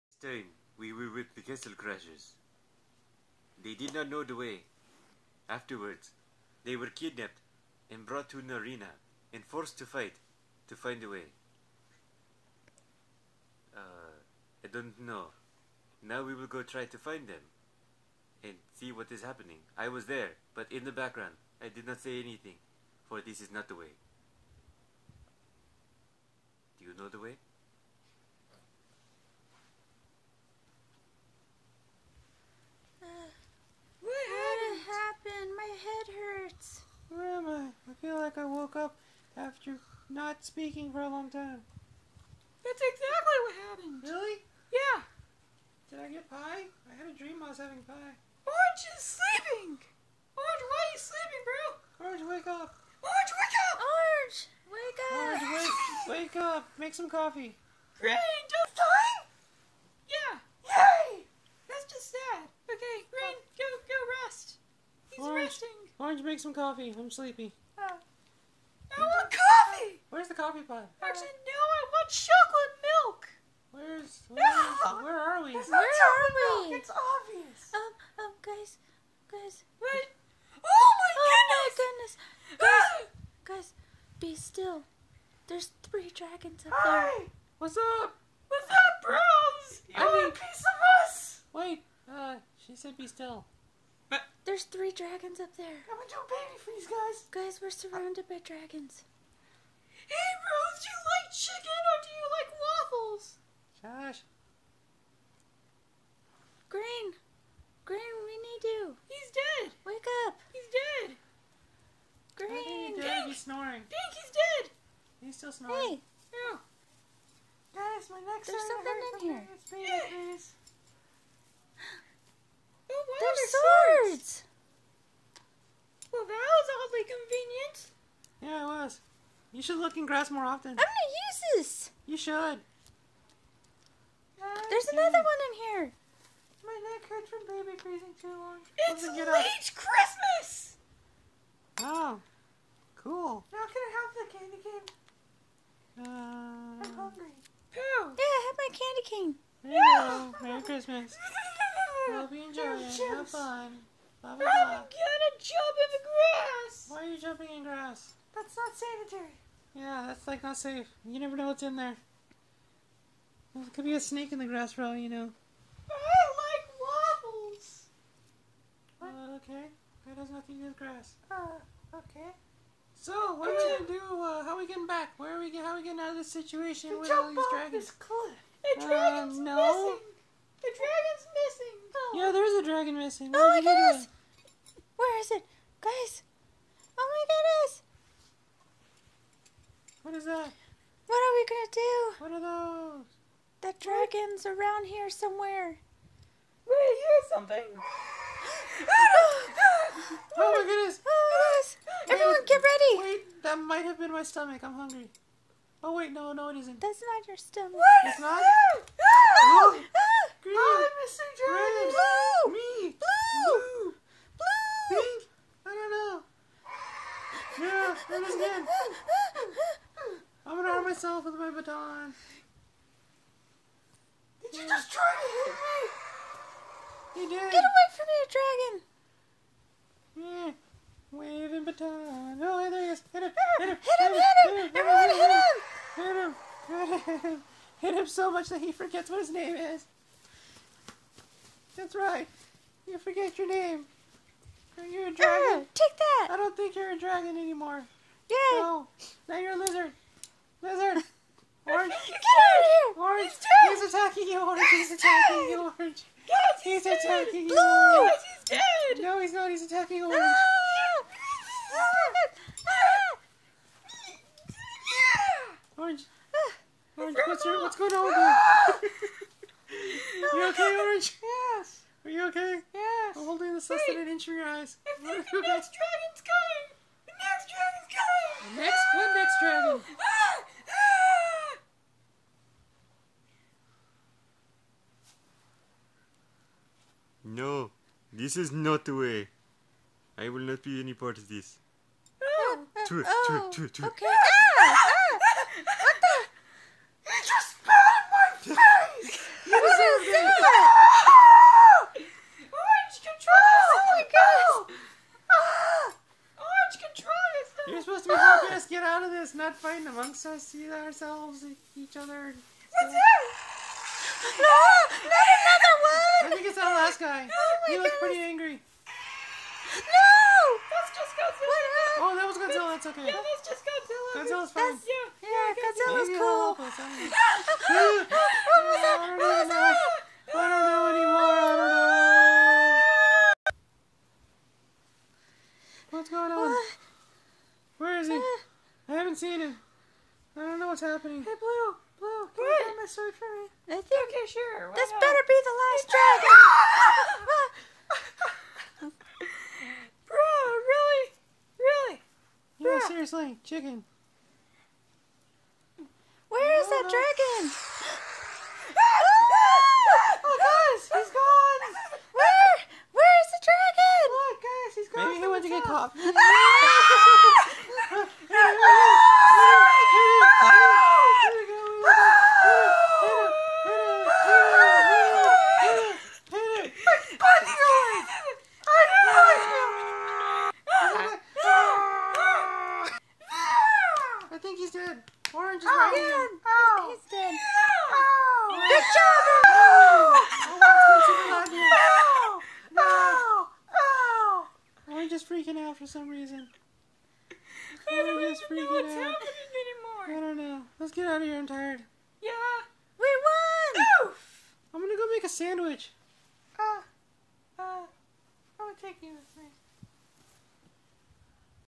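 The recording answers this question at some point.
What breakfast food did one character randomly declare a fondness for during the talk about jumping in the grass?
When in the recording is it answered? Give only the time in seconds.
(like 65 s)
167 s.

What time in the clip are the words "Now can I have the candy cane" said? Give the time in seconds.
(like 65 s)
143 s.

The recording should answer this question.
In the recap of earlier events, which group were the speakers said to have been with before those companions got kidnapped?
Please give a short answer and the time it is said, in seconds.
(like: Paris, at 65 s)
Castle Crashers, at 1 s.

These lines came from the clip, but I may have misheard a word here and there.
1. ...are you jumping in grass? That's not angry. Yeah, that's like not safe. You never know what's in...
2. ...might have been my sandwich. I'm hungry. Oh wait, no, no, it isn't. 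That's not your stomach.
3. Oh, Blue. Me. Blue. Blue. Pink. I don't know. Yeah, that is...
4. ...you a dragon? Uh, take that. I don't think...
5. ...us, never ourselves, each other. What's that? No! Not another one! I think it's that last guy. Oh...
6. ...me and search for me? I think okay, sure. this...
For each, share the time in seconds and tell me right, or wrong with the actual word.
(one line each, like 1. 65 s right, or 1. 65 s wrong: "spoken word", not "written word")
1. 157 s wrong: "sanitary", not "angry"
2. 203 s wrong: "stomach", not "sandwich"
3. 210 s right
4. 244 s right
5. 310 s wrong: "either", not "never"
6. 342 s right.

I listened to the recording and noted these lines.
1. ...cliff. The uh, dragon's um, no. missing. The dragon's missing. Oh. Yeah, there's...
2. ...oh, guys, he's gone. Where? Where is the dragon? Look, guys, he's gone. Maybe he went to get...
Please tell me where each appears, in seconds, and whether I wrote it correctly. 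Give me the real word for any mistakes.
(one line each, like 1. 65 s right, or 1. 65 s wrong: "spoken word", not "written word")
1. 177 s right
2. 360 s right.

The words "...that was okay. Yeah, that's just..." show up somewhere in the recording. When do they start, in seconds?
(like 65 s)
322 s.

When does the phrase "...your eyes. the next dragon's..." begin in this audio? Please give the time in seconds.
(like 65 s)
274 s.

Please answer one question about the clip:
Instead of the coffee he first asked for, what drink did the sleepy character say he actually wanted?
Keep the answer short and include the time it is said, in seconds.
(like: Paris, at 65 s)
chocolate milk, at 72 s.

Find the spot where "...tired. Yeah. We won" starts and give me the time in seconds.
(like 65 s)
401 s.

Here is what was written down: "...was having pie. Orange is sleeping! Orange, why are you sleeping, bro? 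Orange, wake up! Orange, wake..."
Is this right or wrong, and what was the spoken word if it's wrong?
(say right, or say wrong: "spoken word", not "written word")
right.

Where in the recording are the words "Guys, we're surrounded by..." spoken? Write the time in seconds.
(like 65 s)
97 s.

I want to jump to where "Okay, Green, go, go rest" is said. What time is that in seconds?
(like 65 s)
62 s.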